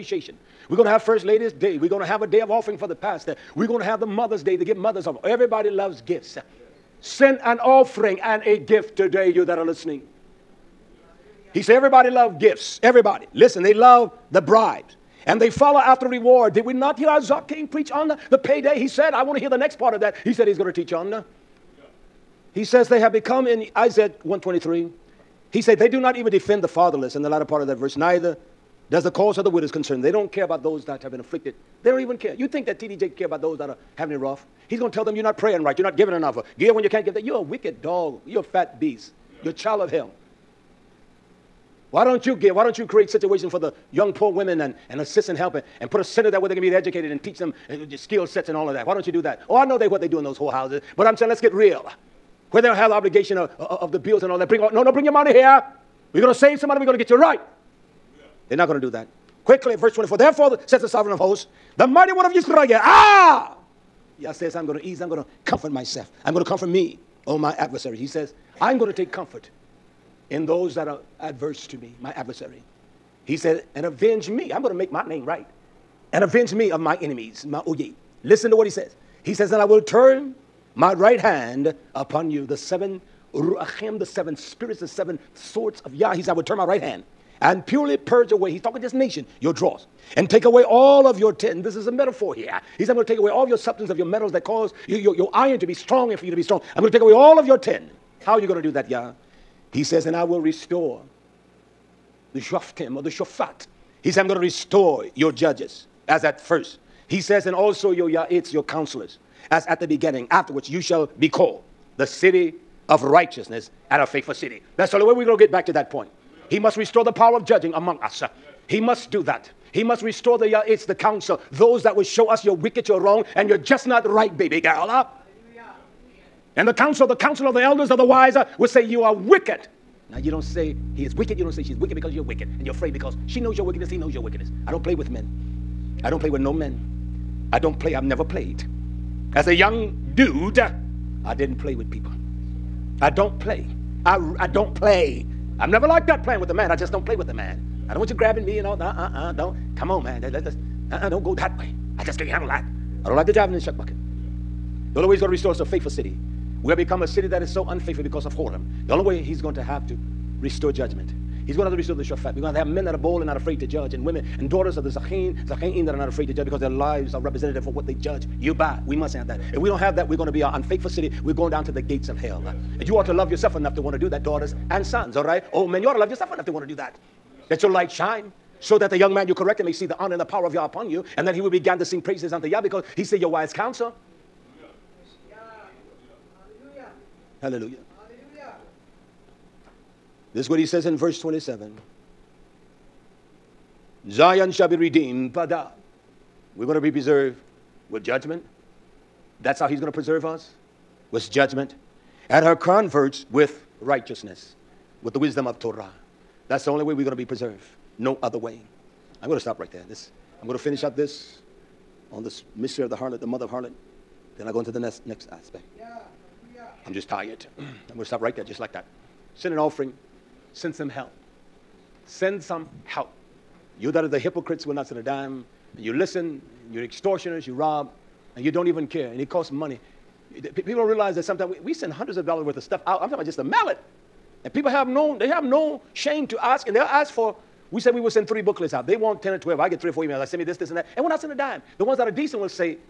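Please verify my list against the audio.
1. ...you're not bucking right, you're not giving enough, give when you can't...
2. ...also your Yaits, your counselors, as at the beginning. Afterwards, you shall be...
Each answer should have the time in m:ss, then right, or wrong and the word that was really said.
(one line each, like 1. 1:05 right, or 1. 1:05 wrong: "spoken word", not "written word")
1. 0:35 wrong: "praying", not "bucking"
2. 1:47 right.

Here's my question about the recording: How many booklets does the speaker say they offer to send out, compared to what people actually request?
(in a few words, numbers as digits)
3.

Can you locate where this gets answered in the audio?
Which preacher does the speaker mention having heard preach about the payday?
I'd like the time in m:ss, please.
0:17.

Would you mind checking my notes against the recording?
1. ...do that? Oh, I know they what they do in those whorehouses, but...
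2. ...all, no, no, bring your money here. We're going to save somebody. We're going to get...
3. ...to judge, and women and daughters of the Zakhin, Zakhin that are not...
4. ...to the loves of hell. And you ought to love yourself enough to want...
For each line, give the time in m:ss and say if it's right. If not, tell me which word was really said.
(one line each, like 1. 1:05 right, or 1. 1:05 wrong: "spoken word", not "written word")
1. 0:49 right
2. 0:54 right
3. 2:43 right
4. 2:51 wrong: "gates", not "loves".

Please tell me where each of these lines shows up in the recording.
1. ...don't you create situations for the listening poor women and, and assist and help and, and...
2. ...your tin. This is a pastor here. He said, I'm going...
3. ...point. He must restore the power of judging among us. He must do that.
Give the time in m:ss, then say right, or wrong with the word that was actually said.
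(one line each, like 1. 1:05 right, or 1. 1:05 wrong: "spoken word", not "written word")
1. 0:42 wrong: "young", not "listening"
2. 1:31 wrong: "metaphor", not "pastor"
3. 1:55 right.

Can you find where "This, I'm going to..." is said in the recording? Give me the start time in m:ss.
3:29.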